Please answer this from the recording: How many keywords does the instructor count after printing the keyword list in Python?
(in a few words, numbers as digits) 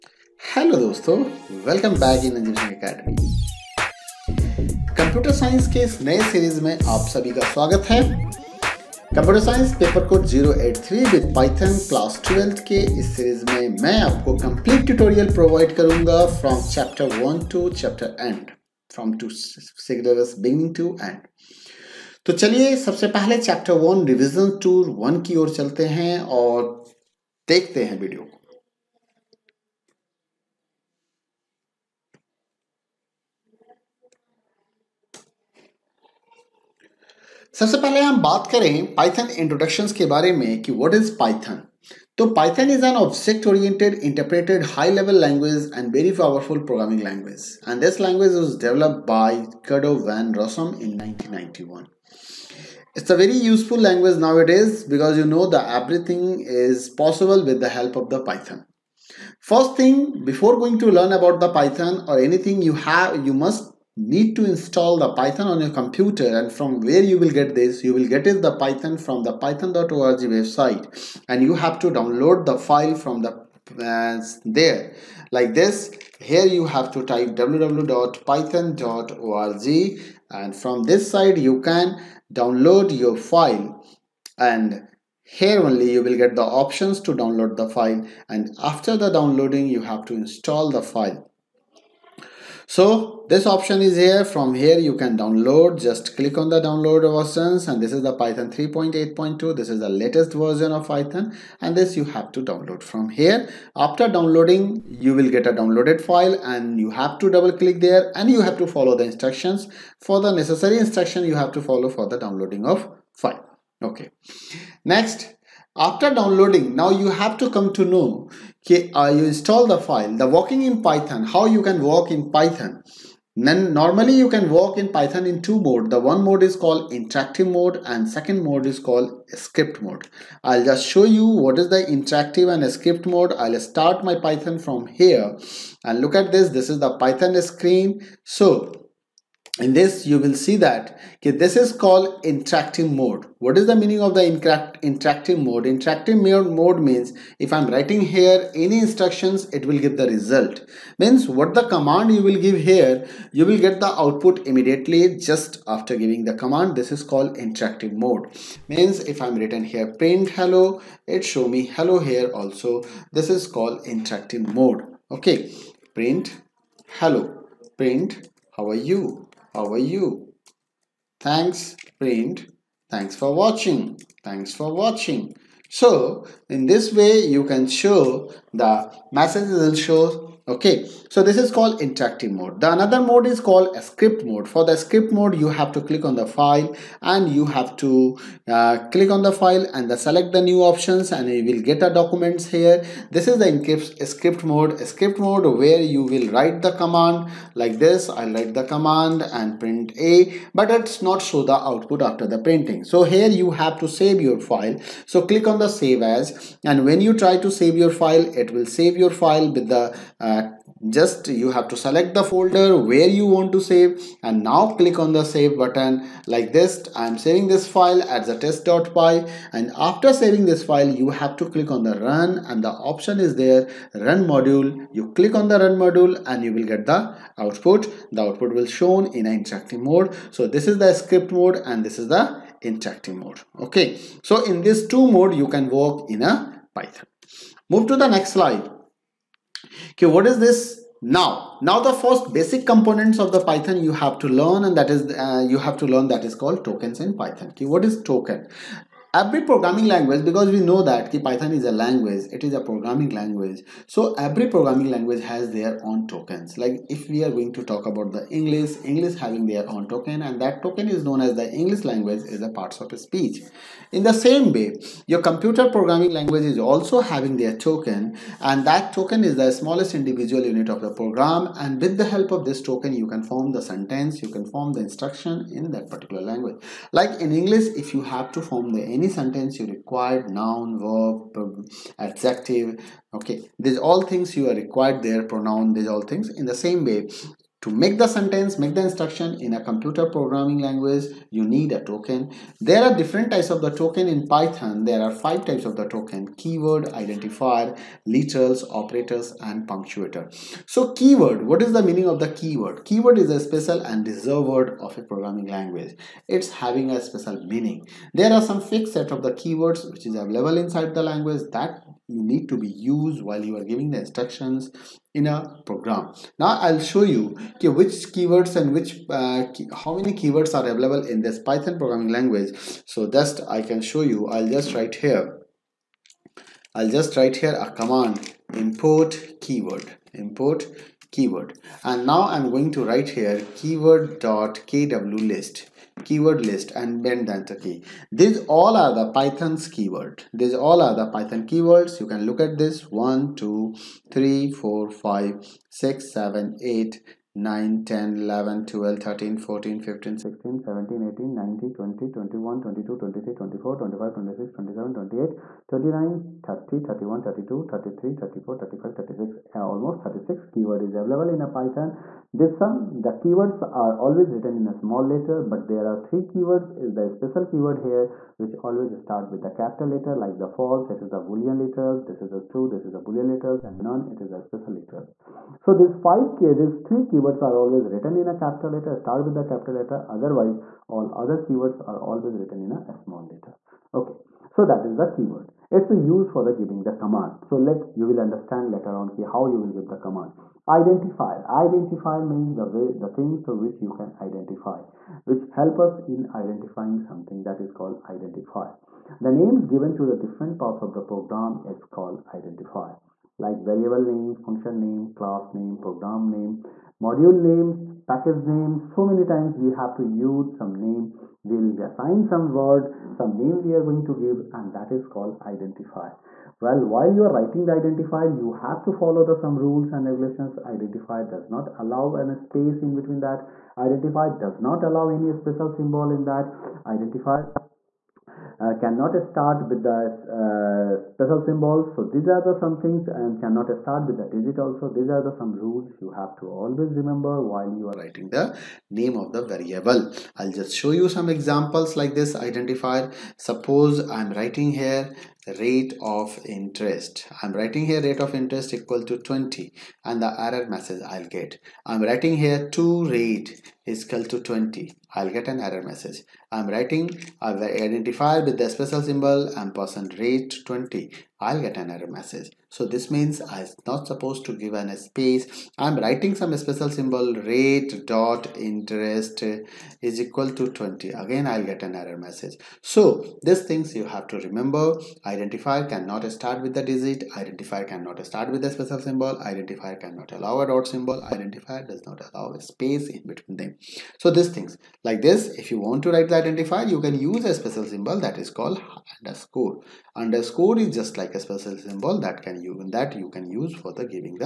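36.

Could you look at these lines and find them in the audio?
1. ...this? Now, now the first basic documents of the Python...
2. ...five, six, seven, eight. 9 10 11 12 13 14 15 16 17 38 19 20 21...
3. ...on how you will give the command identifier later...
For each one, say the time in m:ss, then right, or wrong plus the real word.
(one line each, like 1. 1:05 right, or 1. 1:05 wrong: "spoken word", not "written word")
1. 4:00 wrong: "components", not "documents"
2. 5:44 wrong: "18", not "38"
3. 6:28 wrong: "identifier", not "later".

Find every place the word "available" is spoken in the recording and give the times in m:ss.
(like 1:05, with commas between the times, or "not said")
5:10, 5:20, 6:00.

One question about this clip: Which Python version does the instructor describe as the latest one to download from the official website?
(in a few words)
3.8.2.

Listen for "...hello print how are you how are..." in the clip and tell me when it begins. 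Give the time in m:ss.
2:47.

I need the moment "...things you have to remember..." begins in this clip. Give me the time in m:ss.
7:53.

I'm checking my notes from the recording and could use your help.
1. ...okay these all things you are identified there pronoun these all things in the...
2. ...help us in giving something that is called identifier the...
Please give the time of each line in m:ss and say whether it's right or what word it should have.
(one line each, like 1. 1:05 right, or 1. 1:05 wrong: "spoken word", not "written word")
1. 4:43 wrong: "required", not "identified"
2. 6:35 wrong: "identifying", not "giving".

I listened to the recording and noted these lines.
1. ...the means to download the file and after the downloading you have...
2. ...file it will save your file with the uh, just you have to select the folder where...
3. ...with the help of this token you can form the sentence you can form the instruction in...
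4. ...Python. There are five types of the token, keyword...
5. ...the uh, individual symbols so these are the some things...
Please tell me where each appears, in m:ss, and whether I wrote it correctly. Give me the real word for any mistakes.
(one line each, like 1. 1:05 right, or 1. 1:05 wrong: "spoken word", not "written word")
1. 1:26 wrong: "options", not "means"
2. 3:27 right
3. 4:31 right
4. 4:54 right
5. 7:09 wrong: "special", not "individual".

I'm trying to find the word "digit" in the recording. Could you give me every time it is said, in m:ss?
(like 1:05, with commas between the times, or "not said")
7:14, 7:56.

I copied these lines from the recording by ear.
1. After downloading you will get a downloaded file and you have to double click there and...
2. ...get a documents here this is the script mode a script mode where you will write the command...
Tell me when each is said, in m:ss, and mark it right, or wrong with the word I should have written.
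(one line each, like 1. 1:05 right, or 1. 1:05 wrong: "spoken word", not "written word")
1. 1:43 right
2. 3:11 right.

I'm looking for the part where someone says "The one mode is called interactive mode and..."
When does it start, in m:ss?
2:05.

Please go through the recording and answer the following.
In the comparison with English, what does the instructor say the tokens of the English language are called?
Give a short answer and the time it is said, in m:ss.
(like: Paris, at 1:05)
parts of speech, at 4:22.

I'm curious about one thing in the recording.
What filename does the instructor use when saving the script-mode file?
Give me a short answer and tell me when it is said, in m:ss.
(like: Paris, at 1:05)
test.py, at 3:38.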